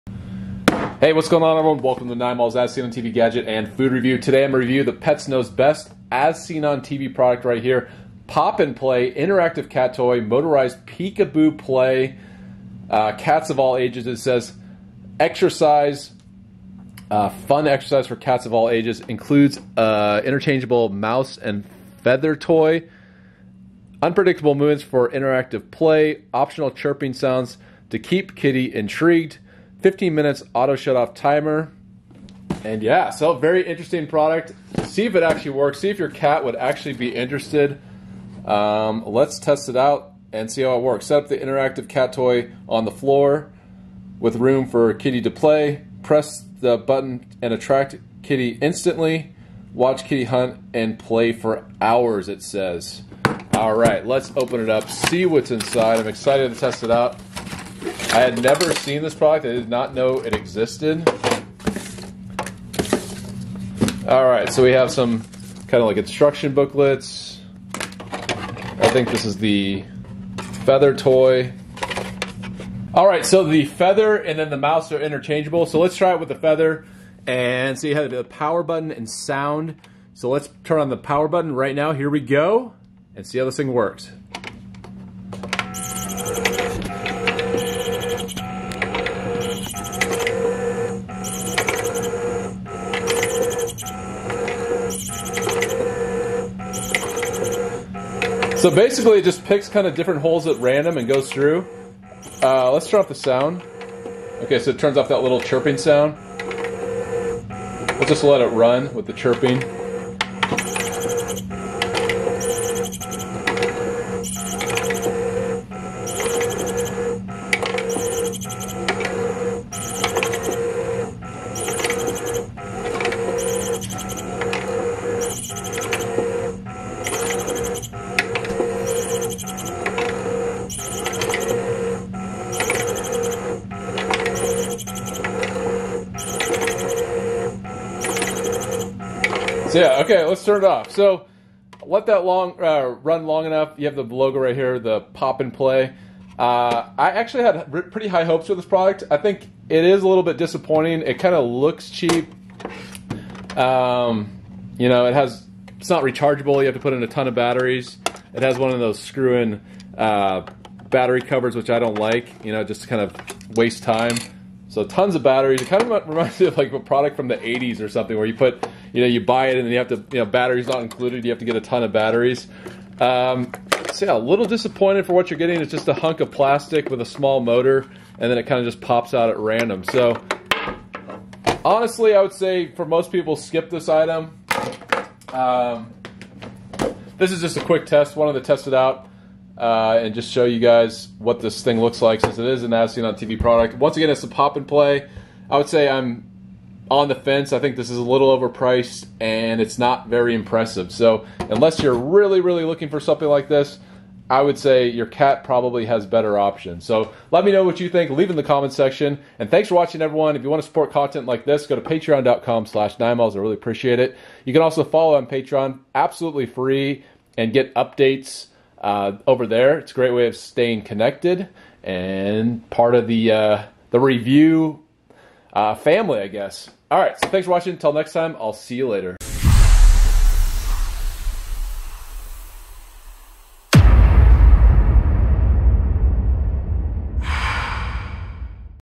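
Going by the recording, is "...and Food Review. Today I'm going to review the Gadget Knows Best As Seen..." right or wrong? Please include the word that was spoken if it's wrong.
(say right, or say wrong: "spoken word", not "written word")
wrong: "Pets", not "Gadget".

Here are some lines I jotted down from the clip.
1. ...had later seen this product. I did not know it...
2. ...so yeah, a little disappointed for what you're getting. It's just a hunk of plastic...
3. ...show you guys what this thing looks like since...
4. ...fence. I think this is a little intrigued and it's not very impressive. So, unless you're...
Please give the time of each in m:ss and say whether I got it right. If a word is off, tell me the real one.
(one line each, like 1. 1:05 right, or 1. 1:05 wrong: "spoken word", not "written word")
1. 0:58 wrong: "never", not "later"
2. 2:53 right
3. 3:10 right
4. 3:17 wrong: "overpriced", not "intrigued".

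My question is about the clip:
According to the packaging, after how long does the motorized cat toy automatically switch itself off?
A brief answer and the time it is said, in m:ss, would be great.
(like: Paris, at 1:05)
15 minutes, at 0:29.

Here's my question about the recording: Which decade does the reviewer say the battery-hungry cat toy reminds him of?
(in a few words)
the 80s.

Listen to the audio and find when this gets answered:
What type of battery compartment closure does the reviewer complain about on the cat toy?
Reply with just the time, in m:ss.
2:38.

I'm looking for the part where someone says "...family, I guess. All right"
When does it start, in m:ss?
3:45.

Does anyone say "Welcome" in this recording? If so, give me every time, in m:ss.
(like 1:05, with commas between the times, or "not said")
0:01.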